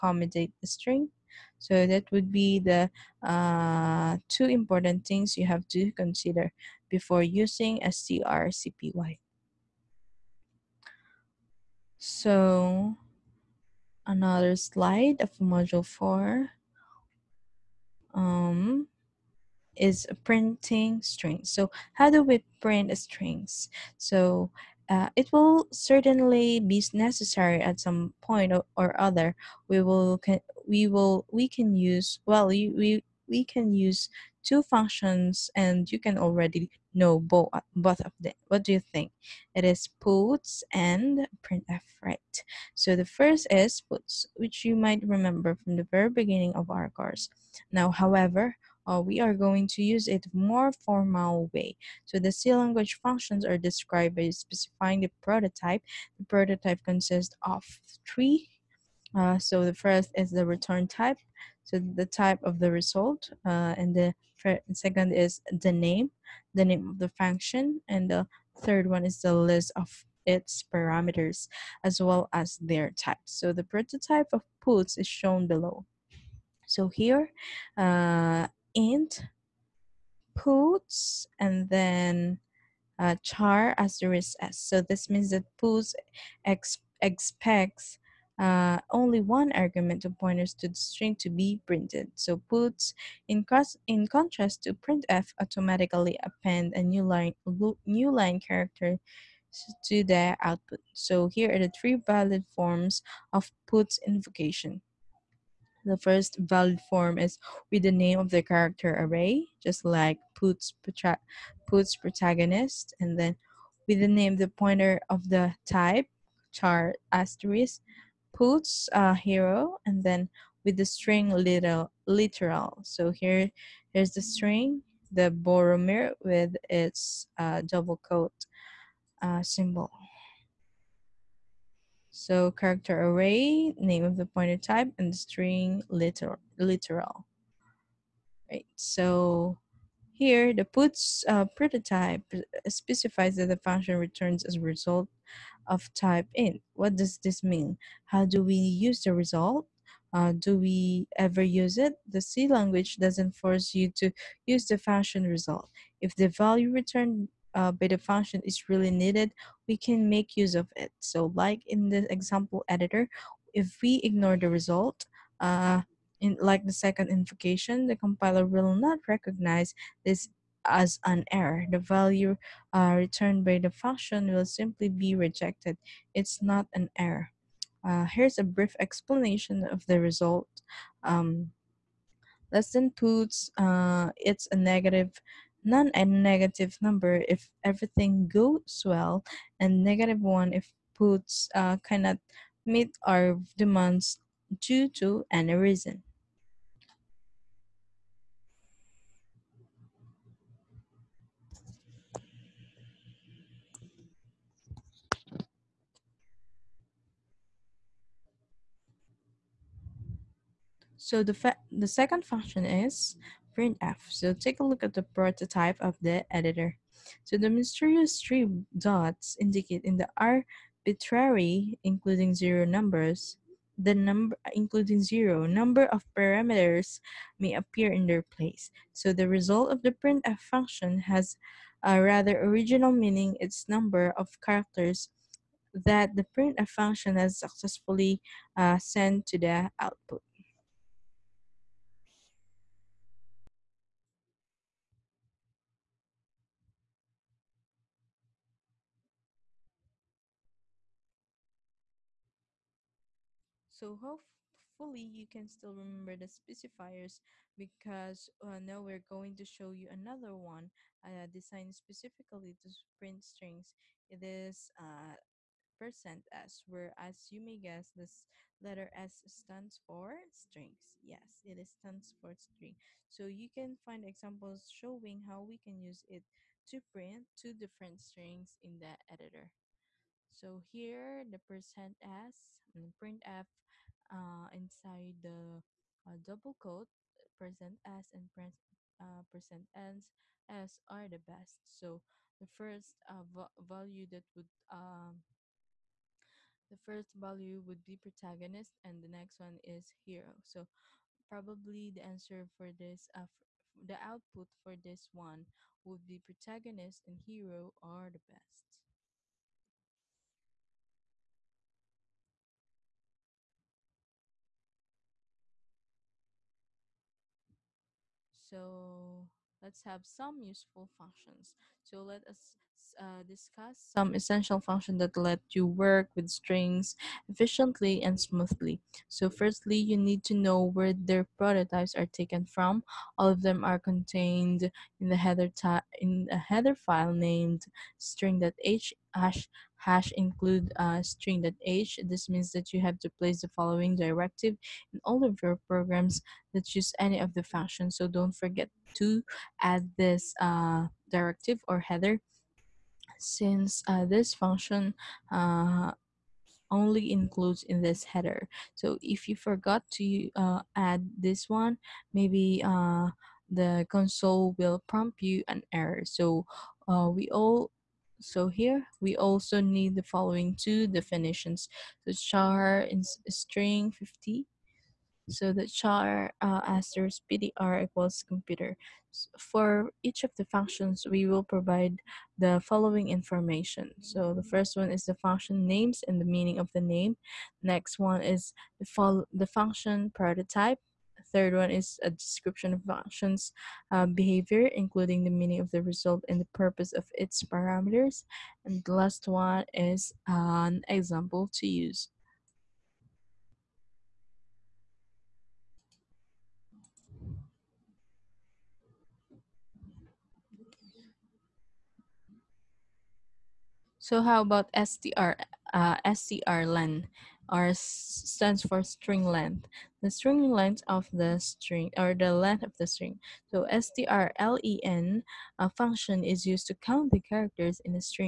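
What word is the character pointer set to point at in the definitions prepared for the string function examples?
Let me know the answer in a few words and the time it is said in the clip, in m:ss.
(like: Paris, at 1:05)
computer, at 6:18.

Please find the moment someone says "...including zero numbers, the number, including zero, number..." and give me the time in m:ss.
3:41.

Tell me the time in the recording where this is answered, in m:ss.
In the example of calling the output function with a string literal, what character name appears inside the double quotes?
2:05.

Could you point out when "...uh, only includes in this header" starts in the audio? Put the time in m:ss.
5:55.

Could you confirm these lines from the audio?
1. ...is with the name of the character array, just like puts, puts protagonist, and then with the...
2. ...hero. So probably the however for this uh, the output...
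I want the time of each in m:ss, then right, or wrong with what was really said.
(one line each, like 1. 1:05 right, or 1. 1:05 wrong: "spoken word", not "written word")
1. 1:47 right
2. 5:00 wrong: "answer", not "however".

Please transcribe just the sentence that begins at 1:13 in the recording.
So the prototype of puts is shown below.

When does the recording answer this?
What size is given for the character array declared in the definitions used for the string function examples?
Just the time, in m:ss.
6:13.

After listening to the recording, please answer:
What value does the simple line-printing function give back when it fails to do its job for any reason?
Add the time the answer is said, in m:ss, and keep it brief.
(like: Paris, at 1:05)
-1, at 3:09.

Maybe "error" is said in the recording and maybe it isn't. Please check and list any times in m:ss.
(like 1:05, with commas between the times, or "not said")
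2:51, 2:56, 6:05.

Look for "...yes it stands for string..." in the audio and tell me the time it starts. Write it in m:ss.
4:31.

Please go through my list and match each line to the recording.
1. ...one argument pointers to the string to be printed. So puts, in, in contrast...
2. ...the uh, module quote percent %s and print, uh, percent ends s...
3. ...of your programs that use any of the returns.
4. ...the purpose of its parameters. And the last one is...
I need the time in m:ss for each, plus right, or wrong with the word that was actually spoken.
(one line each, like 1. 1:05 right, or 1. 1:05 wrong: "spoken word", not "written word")
1. 1:29 right
2. 4:45 wrong: "double", not "module"
3. 5:45 wrong: "functions", not "returns"
4. 6:36 right.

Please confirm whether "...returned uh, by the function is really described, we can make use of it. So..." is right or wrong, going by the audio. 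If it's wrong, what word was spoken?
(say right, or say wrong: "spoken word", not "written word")
wrong: "needed", not "described".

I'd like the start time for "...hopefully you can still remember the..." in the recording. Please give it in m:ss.
4:13.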